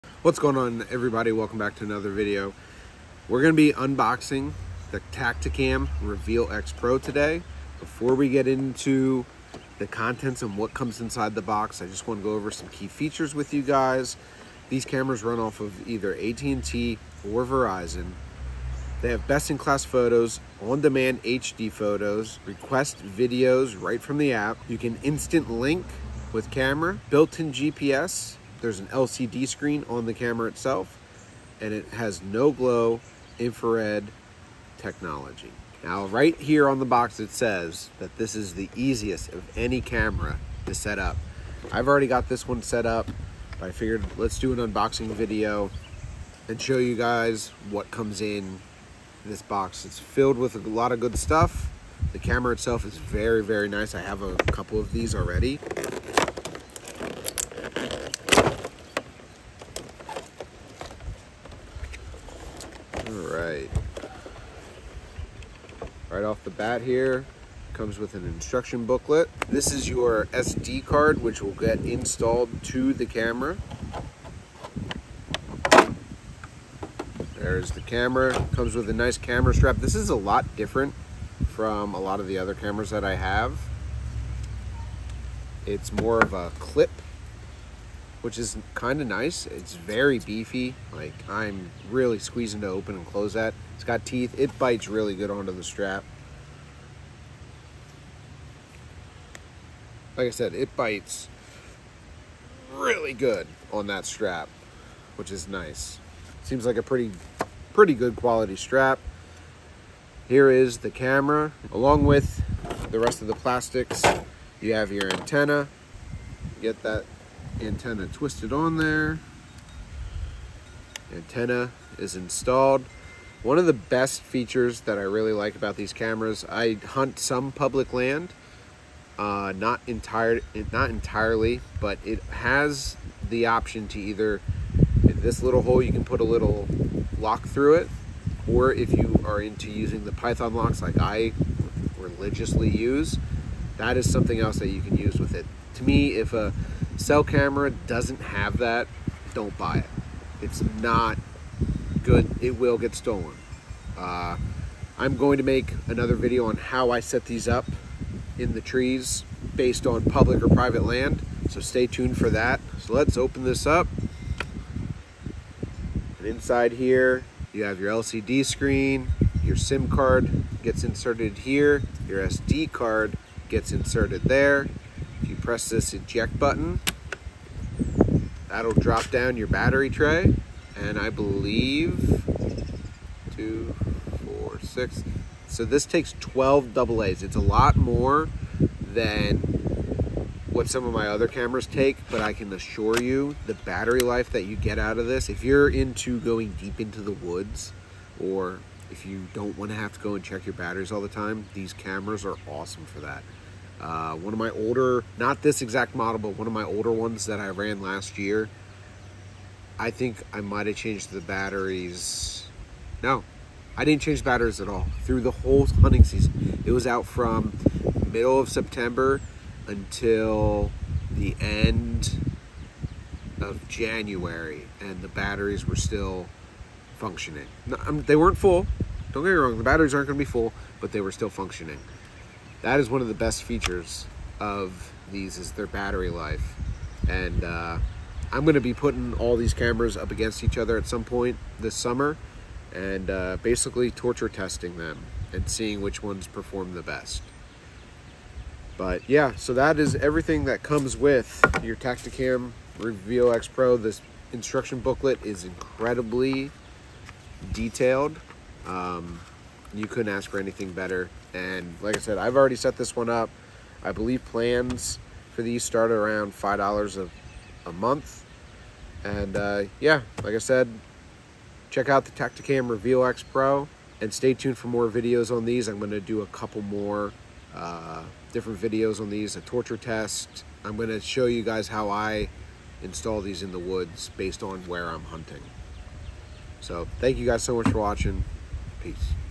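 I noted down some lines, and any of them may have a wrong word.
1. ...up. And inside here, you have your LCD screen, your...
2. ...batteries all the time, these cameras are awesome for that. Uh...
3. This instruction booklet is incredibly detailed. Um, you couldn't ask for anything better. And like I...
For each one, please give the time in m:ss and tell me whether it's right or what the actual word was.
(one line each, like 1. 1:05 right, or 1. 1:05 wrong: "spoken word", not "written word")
1. 2:43 right
2. 3:20 right
3. 4:13 right.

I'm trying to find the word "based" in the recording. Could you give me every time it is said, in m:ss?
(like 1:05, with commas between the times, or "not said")
2:39, 4:44.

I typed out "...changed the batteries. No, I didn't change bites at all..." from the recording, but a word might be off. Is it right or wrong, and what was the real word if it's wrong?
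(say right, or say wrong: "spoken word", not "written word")
wrong: "batteries", not "bites".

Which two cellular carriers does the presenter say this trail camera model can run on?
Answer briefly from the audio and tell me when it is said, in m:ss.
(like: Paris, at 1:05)
AT&T or Verizon, at 0:16.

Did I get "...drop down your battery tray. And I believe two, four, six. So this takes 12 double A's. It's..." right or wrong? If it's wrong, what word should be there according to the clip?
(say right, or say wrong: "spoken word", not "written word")
right.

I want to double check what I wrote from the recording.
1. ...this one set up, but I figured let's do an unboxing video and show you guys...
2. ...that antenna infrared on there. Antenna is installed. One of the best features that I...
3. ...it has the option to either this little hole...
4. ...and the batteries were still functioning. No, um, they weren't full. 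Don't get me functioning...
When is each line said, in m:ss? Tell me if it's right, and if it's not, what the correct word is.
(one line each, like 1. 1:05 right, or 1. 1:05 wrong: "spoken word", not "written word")
1. 0:42 right
2. 1:56 wrong: "twisted", not "infrared"
3. 2:12 right
4. 3:44 wrong: "wrong", not "functioning".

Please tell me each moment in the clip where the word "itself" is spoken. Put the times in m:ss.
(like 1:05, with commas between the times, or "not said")
0:30, 0:52.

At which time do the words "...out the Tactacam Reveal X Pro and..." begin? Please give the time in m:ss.
4:31.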